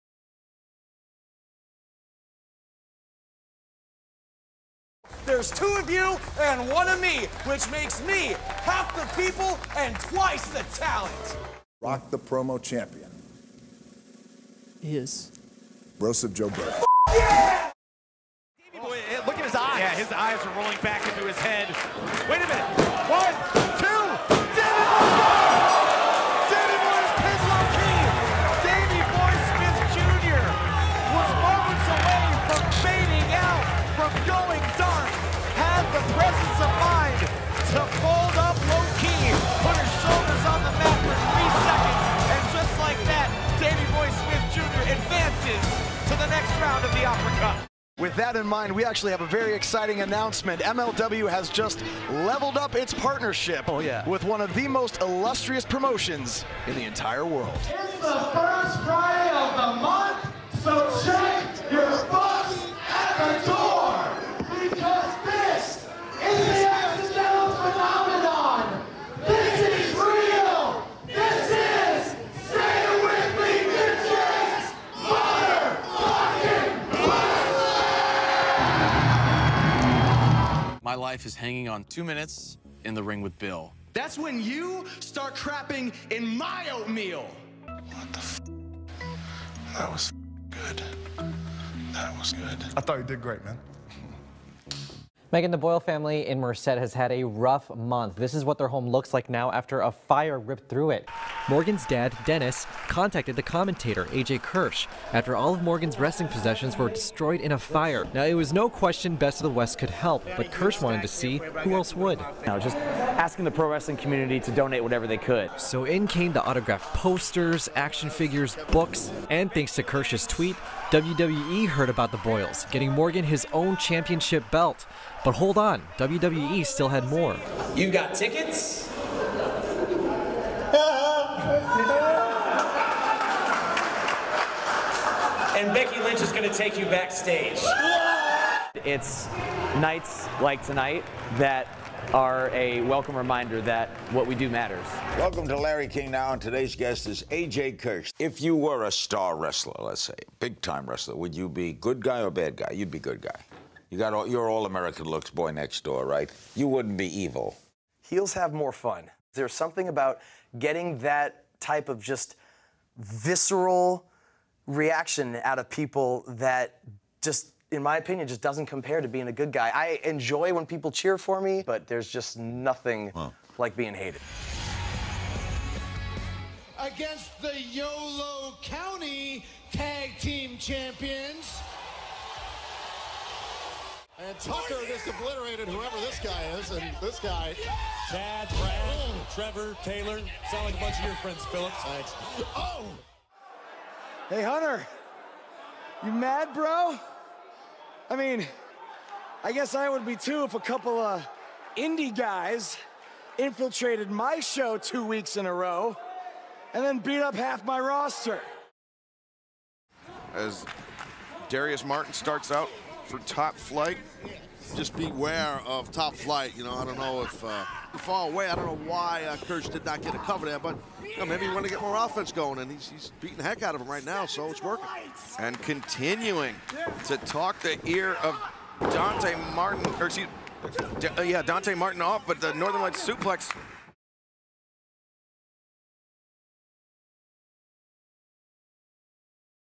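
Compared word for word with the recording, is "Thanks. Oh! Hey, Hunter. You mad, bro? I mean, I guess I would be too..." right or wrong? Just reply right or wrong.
right.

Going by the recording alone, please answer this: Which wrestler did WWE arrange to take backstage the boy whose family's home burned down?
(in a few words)
Becky Lynch.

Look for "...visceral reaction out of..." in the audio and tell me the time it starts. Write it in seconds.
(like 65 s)
162 s.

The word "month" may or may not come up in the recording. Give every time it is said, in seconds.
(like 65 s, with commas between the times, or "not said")
59 s, 97 s.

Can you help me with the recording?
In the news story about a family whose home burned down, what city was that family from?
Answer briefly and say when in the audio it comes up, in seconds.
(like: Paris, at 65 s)
Merced, at 96 s.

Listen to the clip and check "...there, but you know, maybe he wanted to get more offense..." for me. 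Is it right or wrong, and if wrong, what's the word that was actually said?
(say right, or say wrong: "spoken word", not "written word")
right.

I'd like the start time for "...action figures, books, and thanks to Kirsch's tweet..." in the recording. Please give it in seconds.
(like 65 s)
117 s.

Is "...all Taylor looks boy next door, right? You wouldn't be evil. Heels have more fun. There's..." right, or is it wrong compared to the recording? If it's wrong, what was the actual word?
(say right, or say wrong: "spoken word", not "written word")
wrong: "American", not "Taylor".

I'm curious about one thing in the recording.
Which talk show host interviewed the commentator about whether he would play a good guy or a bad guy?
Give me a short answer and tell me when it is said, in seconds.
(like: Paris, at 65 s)
Larry King, at 145 s.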